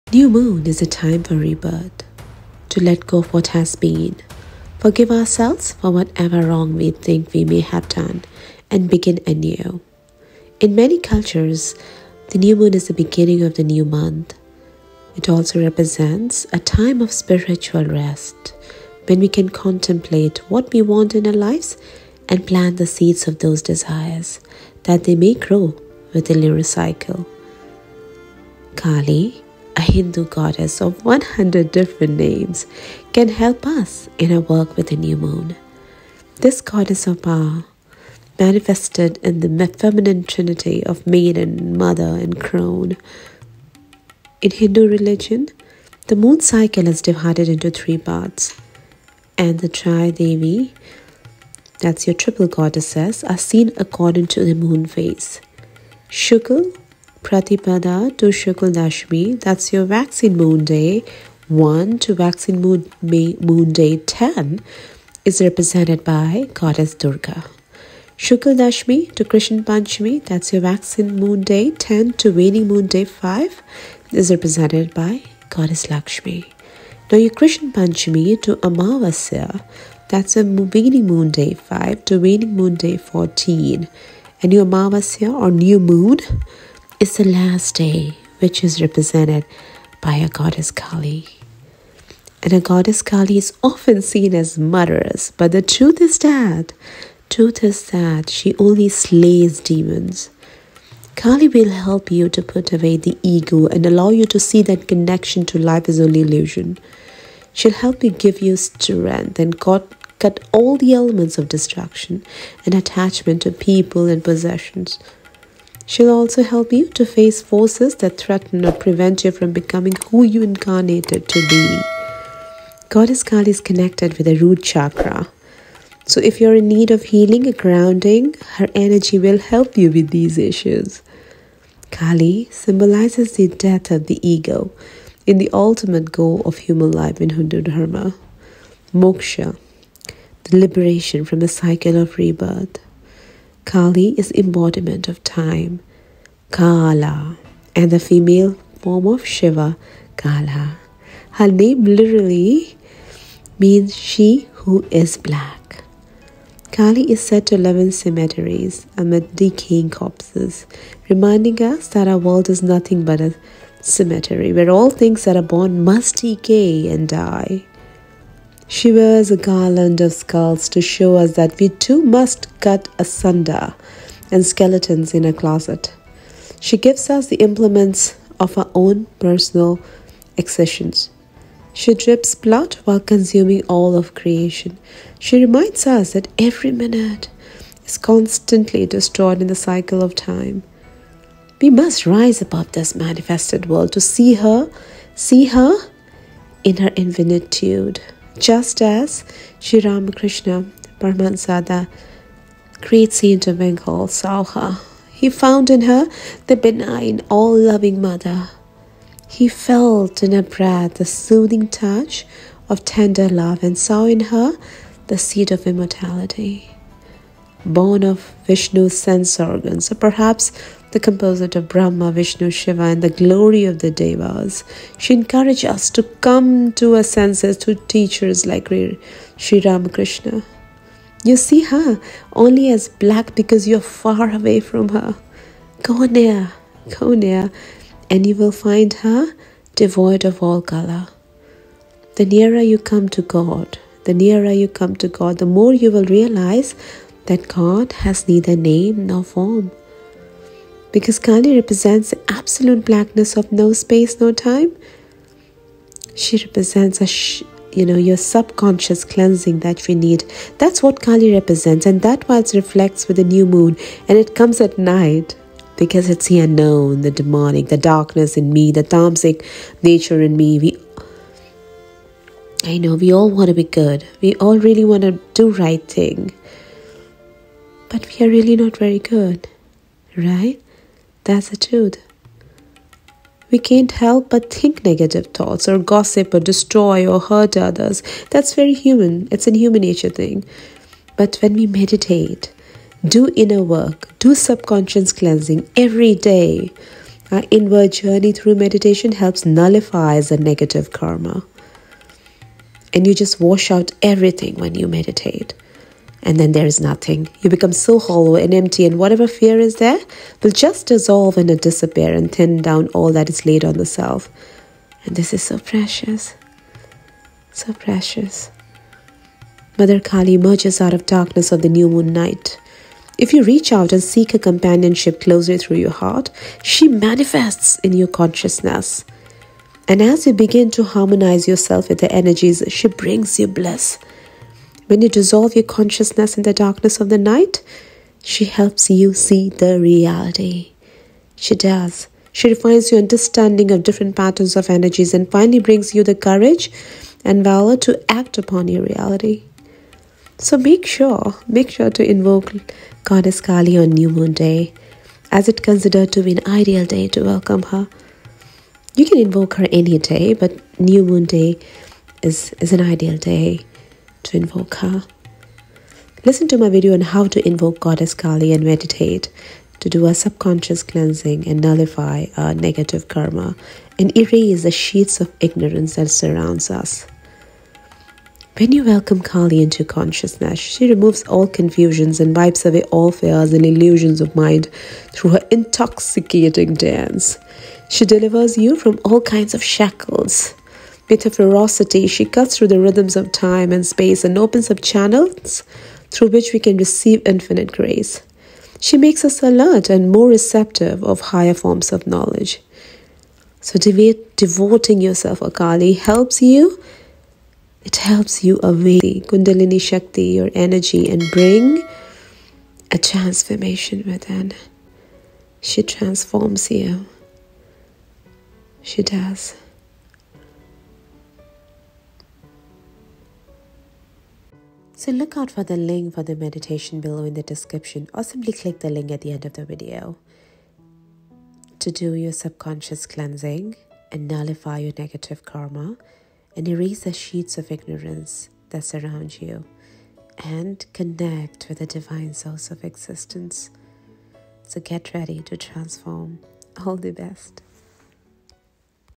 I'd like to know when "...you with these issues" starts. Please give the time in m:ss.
2:09.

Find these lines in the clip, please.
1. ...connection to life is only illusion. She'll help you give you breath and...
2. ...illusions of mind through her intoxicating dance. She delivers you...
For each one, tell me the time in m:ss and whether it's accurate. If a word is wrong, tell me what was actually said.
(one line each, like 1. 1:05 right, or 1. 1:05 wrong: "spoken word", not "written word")
1. 1:44 wrong: "strength", not "breath"
2. 6:23 right.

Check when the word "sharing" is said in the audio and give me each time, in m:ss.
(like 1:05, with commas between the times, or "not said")
not said.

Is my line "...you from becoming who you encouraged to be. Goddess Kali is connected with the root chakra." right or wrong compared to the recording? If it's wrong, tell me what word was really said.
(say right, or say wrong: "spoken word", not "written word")
wrong: "incarnated", not "encouraged".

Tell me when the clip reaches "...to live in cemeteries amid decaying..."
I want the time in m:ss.
2:37.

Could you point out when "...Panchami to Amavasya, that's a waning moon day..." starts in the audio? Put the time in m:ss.
1:17.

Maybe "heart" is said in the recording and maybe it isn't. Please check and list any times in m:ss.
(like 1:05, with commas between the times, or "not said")
5:25.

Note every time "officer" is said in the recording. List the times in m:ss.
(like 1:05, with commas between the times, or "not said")
not said.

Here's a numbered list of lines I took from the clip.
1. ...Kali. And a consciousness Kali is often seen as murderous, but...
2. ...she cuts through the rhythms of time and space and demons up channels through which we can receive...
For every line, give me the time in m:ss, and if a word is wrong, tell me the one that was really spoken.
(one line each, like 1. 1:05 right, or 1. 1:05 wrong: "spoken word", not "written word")
1. 1:30 wrong: "goddess", not "consciousness"
2. 6:32 wrong: "opens", not "demons".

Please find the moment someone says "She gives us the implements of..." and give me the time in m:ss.
2:56.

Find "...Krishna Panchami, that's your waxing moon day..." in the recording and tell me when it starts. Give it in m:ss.
1:09.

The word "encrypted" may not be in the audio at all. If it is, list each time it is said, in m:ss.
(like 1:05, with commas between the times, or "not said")
not said.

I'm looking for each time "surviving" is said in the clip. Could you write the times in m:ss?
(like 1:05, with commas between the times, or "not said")
not said.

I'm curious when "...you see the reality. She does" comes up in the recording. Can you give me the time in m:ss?
5:38.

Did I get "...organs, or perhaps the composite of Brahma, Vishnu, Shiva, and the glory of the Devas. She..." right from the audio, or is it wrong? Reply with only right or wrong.
right.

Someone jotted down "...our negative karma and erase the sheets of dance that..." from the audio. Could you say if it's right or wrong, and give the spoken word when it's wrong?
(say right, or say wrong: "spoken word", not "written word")
wrong: "ignorance", not "dance".